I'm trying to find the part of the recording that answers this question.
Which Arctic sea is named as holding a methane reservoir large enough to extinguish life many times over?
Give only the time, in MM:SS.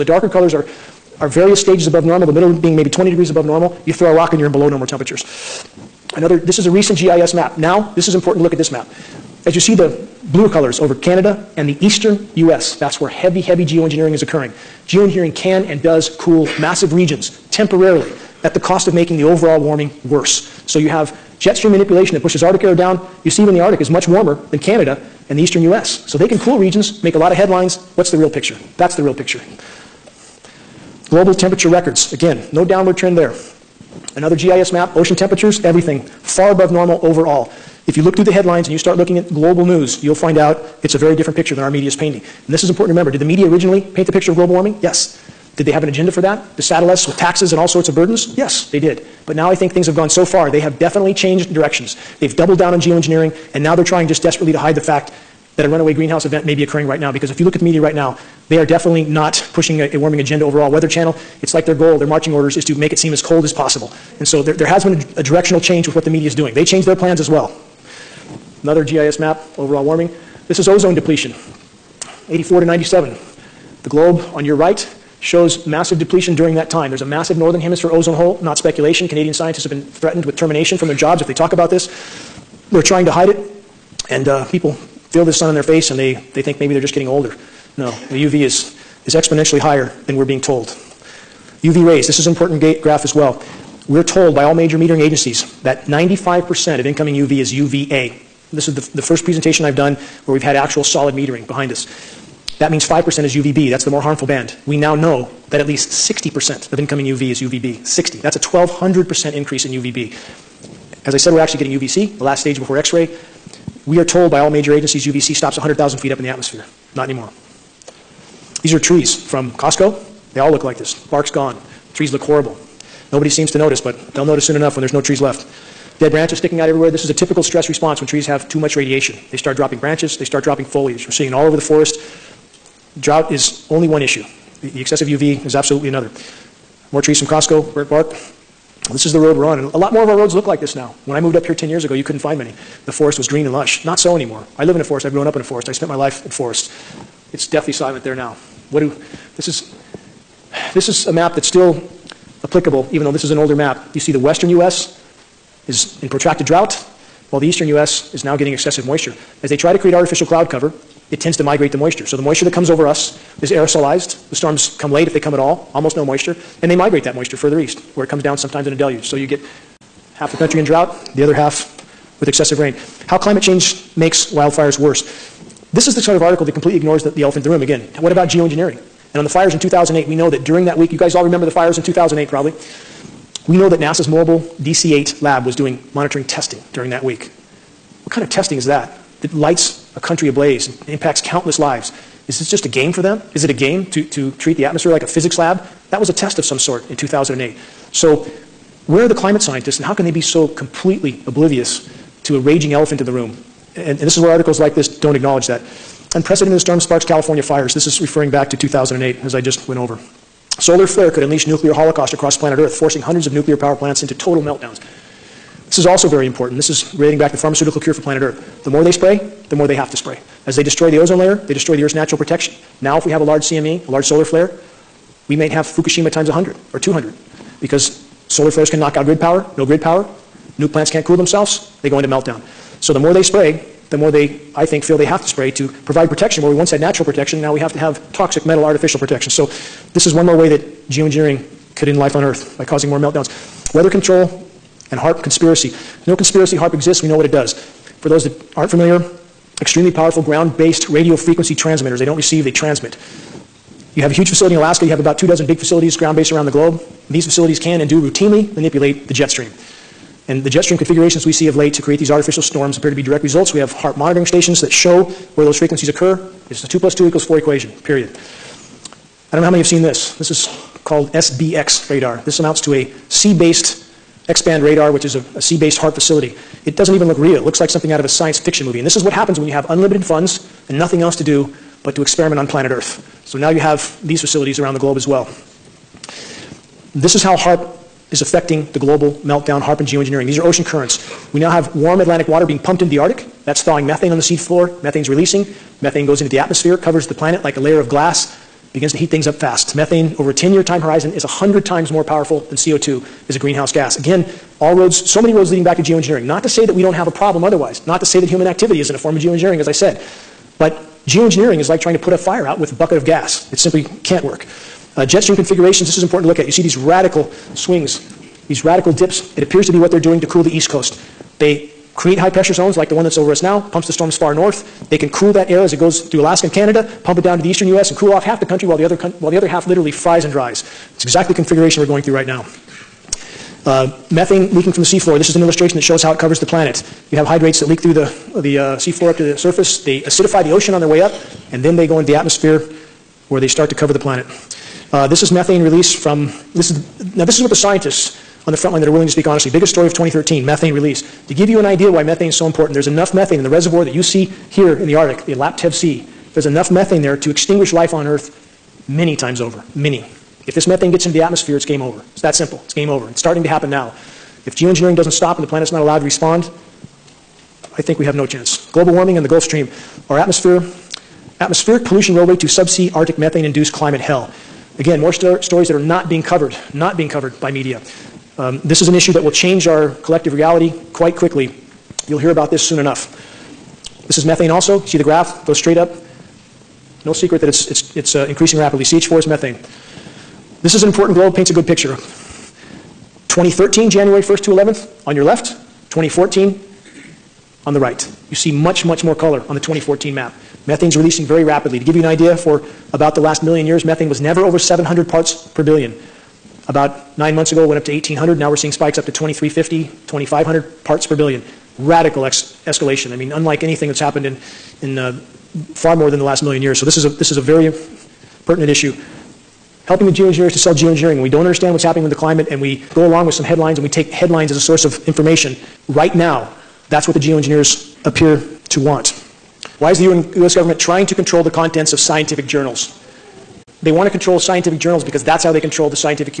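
05:55.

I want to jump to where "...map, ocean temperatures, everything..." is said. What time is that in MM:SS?
00:34.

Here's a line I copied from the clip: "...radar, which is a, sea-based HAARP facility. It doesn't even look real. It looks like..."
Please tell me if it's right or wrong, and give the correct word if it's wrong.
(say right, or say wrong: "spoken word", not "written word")
right.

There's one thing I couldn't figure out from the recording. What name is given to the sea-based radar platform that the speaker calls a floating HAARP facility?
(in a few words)
SBX radar.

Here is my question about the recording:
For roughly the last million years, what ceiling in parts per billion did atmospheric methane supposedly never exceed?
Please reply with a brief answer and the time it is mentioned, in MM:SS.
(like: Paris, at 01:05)
700, at 06:44.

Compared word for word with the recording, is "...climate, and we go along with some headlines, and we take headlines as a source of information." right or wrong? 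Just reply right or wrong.
right.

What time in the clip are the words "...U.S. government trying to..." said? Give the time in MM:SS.
07:10.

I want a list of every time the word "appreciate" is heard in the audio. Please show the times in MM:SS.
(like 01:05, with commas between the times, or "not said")
not said.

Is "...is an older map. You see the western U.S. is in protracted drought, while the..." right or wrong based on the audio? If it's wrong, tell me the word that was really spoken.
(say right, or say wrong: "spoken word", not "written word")
right.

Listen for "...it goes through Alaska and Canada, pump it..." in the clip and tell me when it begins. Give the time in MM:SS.
05:25.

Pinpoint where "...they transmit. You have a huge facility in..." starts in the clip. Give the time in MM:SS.
04:12.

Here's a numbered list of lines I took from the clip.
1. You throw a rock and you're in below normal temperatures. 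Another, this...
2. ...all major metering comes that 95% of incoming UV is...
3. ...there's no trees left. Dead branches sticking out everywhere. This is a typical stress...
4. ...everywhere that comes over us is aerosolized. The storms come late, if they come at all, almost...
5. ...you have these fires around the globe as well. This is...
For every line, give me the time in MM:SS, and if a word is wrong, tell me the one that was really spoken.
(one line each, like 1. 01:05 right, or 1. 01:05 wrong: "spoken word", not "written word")
1. 00:03 right
2. 01:34 wrong: "agencies", not "comes"
3. 02:04 right
4. 02:42 wrong: "moisture", not "everywhere"
5. 04:43 wrong: "facilities", not "fires".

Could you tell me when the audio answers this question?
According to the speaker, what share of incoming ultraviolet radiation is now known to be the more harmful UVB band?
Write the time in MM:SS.
01:45.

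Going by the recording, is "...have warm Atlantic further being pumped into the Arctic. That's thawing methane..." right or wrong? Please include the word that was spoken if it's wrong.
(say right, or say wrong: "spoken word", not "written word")
wrong: "water", not "further".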